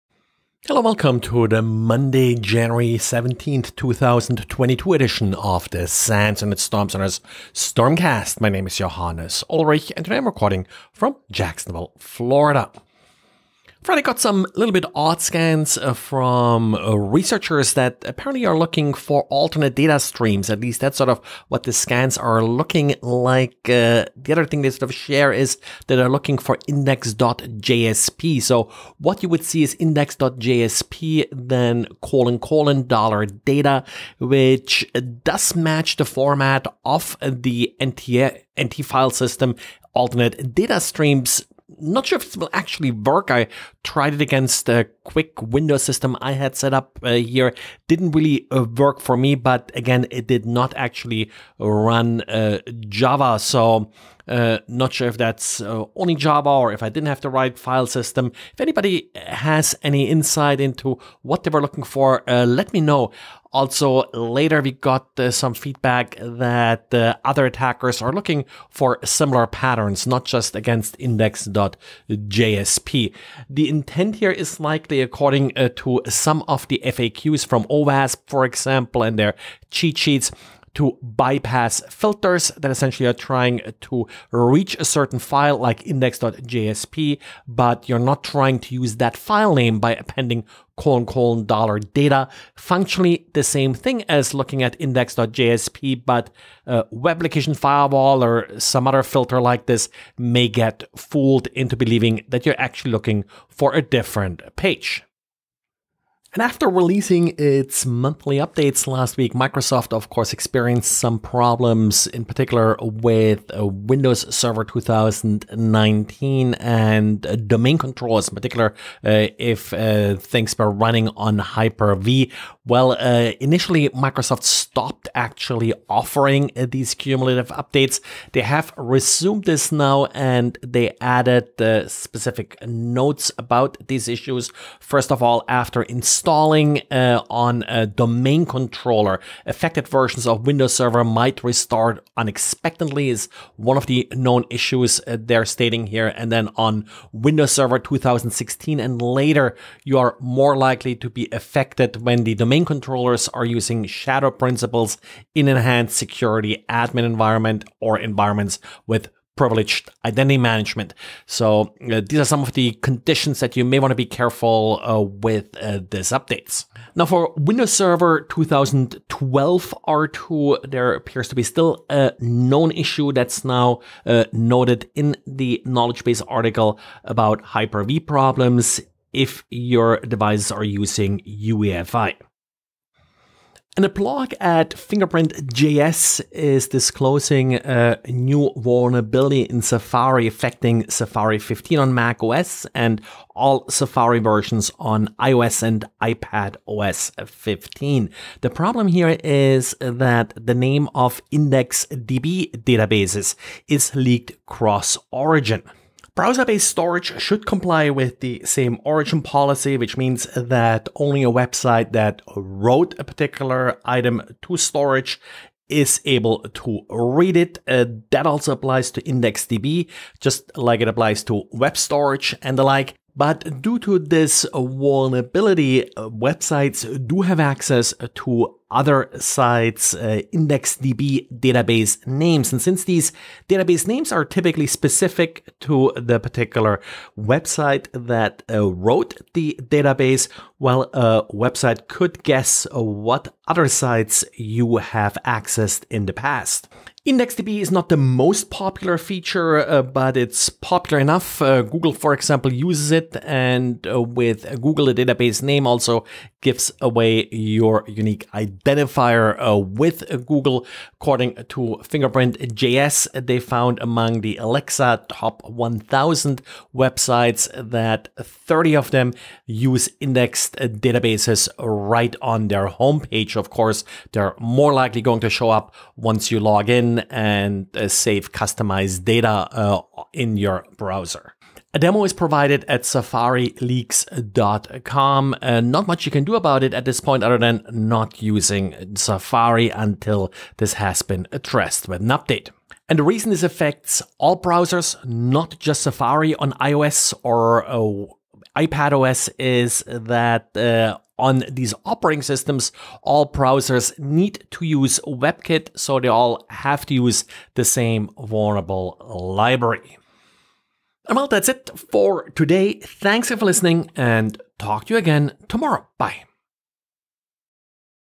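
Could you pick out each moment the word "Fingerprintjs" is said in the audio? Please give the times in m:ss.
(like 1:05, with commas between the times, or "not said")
3:04, 4:21.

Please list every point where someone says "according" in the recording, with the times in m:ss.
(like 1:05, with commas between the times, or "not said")
1:15, 4:20.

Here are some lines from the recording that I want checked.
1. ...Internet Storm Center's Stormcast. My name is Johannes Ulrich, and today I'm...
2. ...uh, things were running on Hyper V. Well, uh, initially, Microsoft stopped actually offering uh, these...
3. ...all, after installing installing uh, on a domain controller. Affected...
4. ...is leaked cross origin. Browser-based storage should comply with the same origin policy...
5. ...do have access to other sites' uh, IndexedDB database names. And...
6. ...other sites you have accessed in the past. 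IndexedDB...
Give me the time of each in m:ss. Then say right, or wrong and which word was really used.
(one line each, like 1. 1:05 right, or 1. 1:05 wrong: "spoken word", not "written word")
1. 0:06 right
2. 1:59 right
3. 2:15 right
4. 3:23 right
5. 3:47 right
6. 4:03 right.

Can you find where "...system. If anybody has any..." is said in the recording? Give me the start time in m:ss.
0:57.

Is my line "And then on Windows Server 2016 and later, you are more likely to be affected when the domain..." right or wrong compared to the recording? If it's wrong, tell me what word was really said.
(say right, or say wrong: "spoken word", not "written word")
right.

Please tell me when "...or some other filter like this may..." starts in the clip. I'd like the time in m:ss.
1:38.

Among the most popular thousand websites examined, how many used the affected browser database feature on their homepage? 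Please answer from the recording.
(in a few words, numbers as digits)
30.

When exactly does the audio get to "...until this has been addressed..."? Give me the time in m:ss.
4:49.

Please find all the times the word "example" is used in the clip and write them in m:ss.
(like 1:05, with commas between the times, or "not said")
1:18, 4:12.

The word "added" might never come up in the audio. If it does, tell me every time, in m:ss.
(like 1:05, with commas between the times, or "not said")
2:11.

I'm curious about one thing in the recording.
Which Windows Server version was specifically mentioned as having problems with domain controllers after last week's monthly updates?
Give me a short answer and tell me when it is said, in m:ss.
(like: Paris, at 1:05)
Windows Server 2019, at 1:53.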